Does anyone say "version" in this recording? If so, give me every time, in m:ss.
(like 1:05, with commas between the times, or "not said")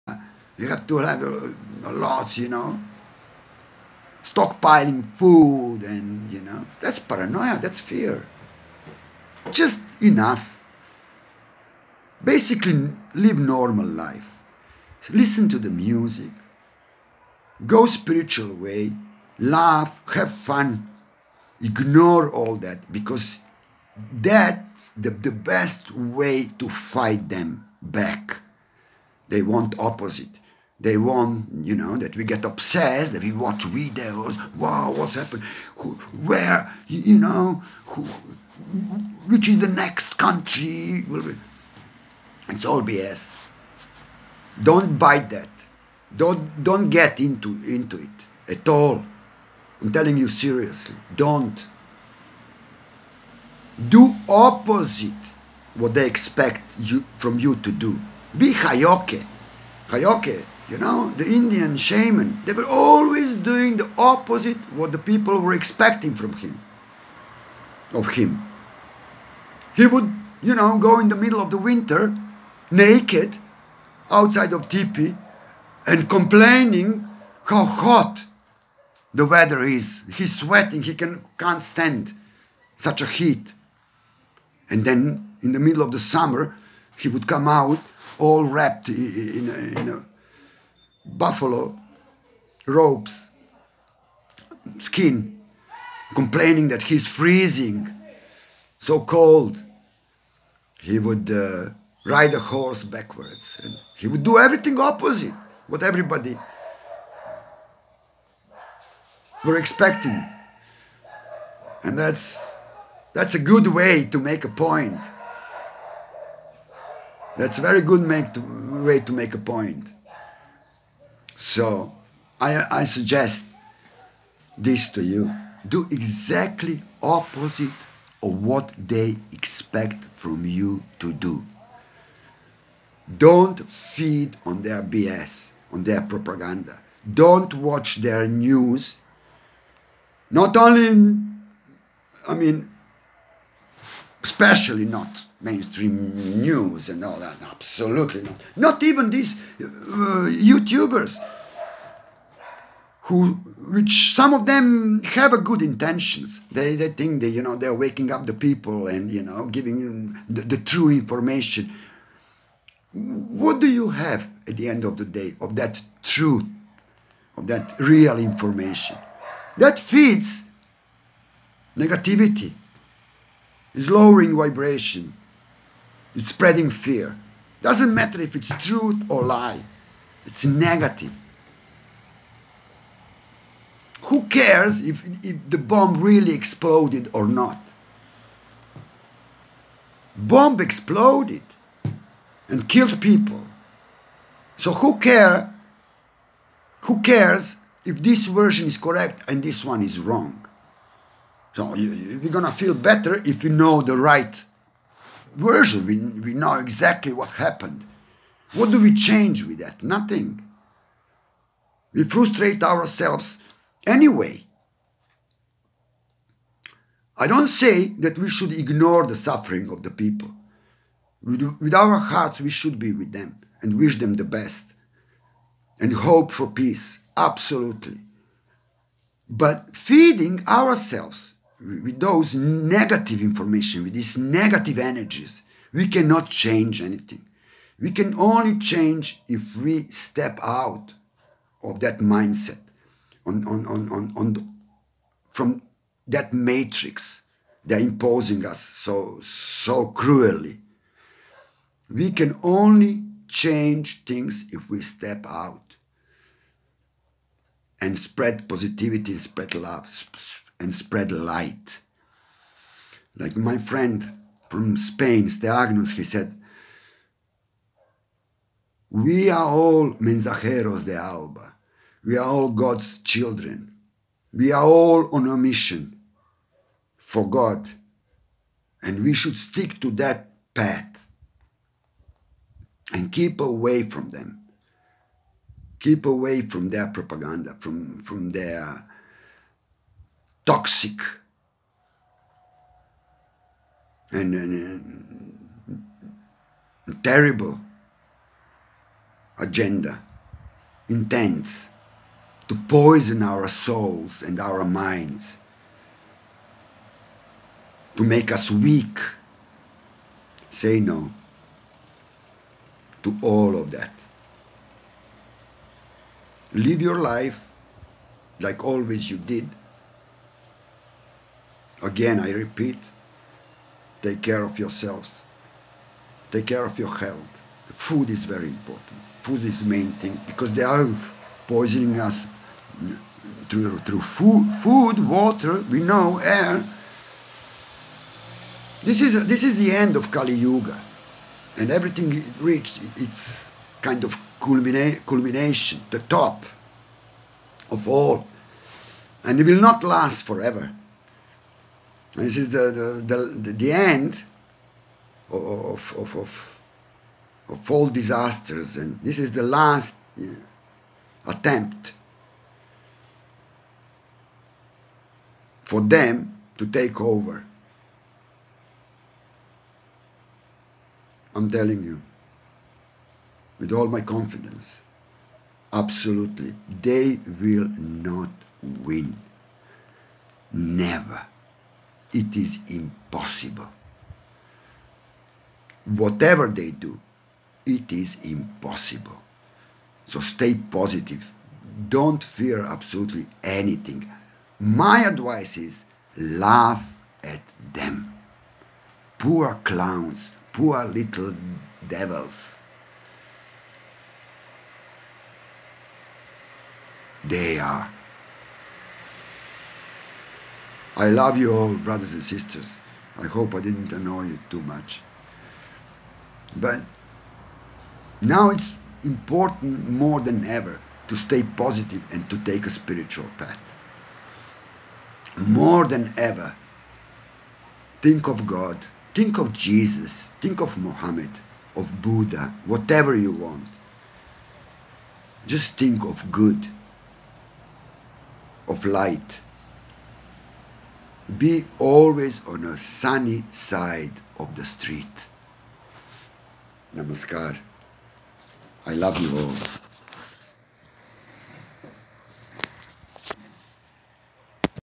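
3:18, 3:25.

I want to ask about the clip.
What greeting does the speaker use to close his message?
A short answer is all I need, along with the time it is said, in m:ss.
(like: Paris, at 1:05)
Namaskar, at 7:26.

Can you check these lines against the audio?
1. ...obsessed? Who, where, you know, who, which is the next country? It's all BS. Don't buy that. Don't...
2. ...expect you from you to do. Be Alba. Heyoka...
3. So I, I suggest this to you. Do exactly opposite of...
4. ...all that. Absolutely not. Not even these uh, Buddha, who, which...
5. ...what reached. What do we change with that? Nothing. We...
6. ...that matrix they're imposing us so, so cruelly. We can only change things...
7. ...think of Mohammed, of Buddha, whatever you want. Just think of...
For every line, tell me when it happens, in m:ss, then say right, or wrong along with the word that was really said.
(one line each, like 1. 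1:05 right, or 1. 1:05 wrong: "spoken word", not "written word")
1. 0:35 wrong: "happened", not "obsessed"
2. 0:56 wrong: "Heyoka", not "Alba"
3. 2:01 right
4. 2:27 wrong: "YouTubers", not "Buddha"
5. 3:27 wrong: "happened", not "reached"
6. 4:06 right
7. 7:10 right.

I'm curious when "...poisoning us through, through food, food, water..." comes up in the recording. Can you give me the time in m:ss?
5:31.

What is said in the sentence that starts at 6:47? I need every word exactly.
They are I love you all, brothers and sisters.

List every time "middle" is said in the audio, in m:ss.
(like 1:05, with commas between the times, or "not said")
1:11, 1:25.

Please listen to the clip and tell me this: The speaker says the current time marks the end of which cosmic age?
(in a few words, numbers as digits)
Kali Yuga.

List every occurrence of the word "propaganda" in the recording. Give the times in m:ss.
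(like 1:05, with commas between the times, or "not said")
2:16, 4:46.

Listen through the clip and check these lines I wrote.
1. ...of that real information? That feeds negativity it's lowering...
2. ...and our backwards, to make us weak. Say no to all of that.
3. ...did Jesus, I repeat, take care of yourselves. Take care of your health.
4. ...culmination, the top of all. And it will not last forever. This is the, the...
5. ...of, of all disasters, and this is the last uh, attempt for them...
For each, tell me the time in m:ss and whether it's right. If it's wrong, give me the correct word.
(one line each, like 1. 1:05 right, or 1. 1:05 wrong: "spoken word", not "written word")
1. 2:47 right
2. 5:04 wrong: "minds", not "backwards"
3. 5:19 wrong: "Again", not "Jesus"
4. 5:45 right
5. 5:56 right.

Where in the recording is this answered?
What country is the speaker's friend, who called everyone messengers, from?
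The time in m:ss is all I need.
4:24.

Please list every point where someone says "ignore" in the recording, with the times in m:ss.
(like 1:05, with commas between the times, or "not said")
0:21, 3:38.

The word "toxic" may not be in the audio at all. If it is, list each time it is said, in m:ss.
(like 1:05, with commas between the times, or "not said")
4:50.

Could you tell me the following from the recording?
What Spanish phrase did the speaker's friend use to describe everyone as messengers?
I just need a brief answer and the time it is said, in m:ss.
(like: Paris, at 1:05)
mensajeros de Alba, at 4:29.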